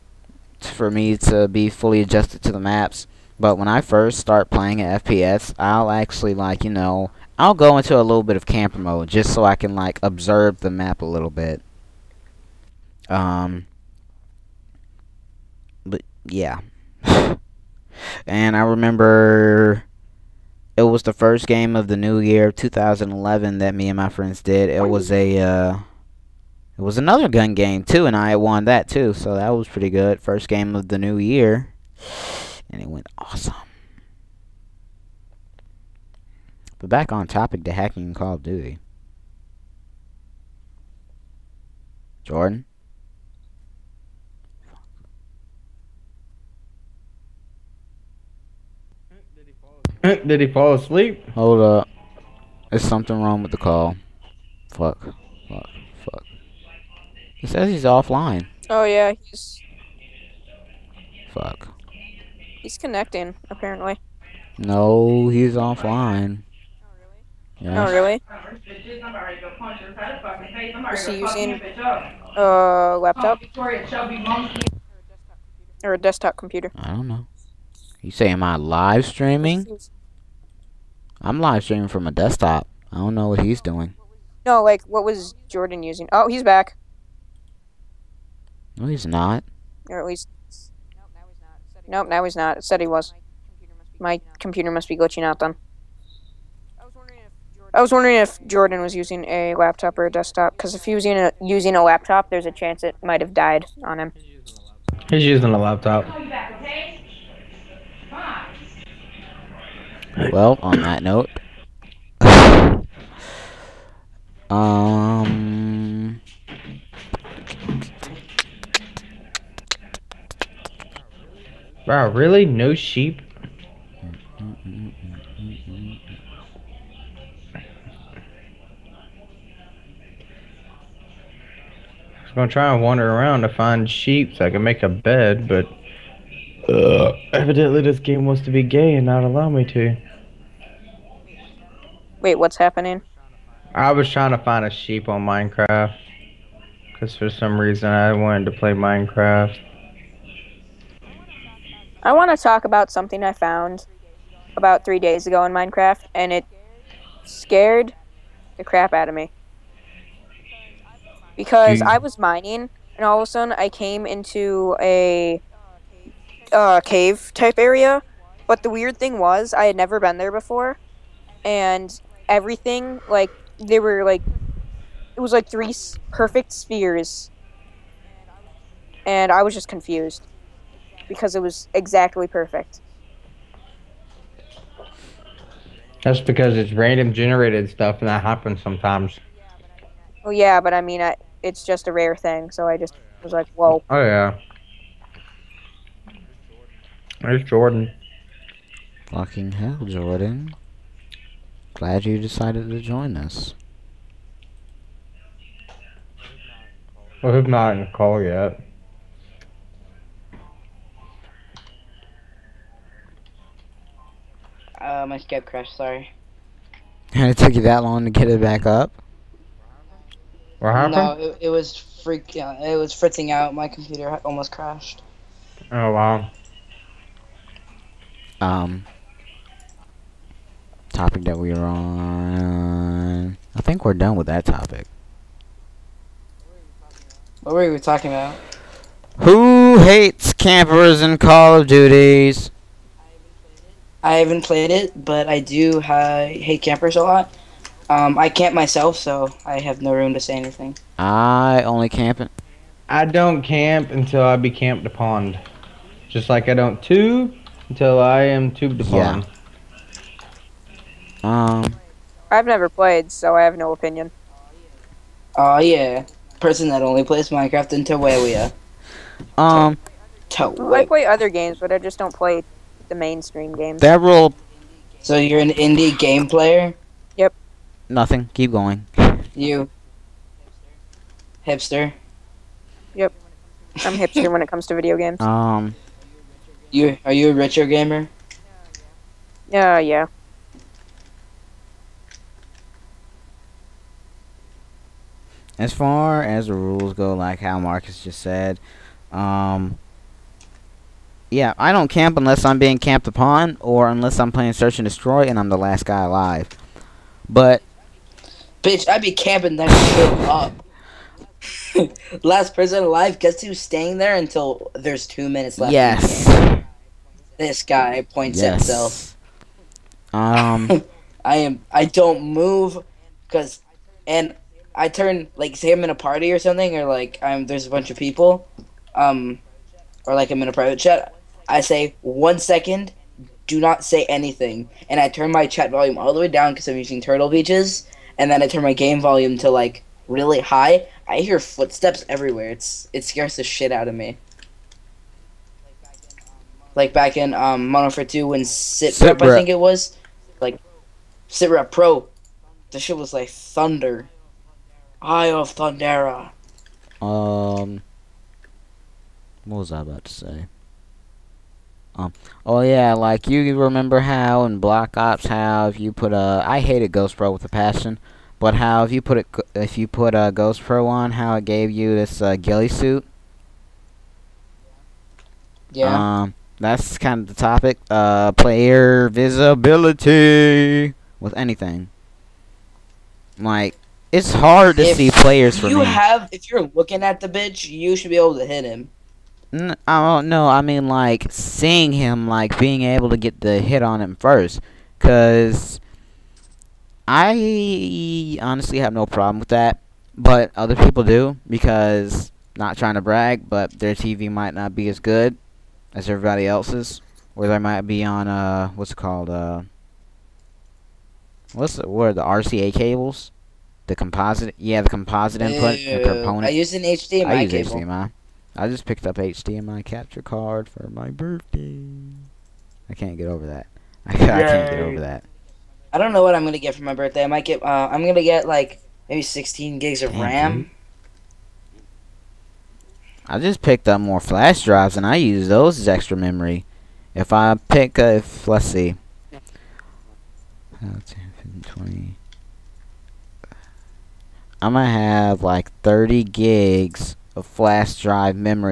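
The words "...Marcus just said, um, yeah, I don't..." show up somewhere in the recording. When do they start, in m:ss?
4:57.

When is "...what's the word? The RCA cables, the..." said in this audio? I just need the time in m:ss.
6:51.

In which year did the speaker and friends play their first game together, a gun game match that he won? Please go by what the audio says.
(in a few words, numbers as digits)
2011.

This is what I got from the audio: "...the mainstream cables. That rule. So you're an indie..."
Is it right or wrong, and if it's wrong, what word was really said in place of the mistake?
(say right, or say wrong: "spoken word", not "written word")
wrong: "games", not "cables".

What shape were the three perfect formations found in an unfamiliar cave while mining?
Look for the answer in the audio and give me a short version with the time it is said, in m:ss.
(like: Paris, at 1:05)
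Spheres, at 2:55.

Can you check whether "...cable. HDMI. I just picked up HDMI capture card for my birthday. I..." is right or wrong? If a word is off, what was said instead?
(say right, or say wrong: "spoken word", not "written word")
right.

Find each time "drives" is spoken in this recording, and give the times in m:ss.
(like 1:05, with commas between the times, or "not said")
7:14, 7:28.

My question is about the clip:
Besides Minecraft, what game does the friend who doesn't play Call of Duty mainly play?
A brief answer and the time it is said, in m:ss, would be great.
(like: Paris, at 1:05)
Terraria, at 4:27.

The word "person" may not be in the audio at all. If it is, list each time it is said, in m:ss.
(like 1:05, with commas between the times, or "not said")
4:26, 5:12.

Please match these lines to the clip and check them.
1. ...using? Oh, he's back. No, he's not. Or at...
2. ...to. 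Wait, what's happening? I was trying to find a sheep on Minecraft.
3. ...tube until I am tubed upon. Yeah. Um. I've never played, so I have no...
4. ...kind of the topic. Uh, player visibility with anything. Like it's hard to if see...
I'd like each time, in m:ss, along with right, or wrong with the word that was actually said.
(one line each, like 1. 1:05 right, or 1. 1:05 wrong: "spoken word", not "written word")
1. 1:25 right
2. 2:19 right
3. 4:16 right
4. 6:16 right.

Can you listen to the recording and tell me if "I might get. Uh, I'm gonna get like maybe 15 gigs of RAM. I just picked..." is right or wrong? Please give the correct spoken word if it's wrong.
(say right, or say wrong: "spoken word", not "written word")
wrong: "16", not "15".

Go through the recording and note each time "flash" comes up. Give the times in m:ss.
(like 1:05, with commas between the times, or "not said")
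7:14, 7:27.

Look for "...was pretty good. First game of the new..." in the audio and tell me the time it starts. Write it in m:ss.
0:29.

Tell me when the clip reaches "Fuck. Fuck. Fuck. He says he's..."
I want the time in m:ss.
0:54.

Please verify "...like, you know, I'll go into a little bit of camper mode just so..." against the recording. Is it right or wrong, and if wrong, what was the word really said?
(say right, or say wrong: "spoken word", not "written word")
right.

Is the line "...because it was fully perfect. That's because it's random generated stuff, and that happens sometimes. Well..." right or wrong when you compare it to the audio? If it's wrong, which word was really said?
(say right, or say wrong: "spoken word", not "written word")
wrong: "exactly", not "fully".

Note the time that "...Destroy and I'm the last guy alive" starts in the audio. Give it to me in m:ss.
5:04.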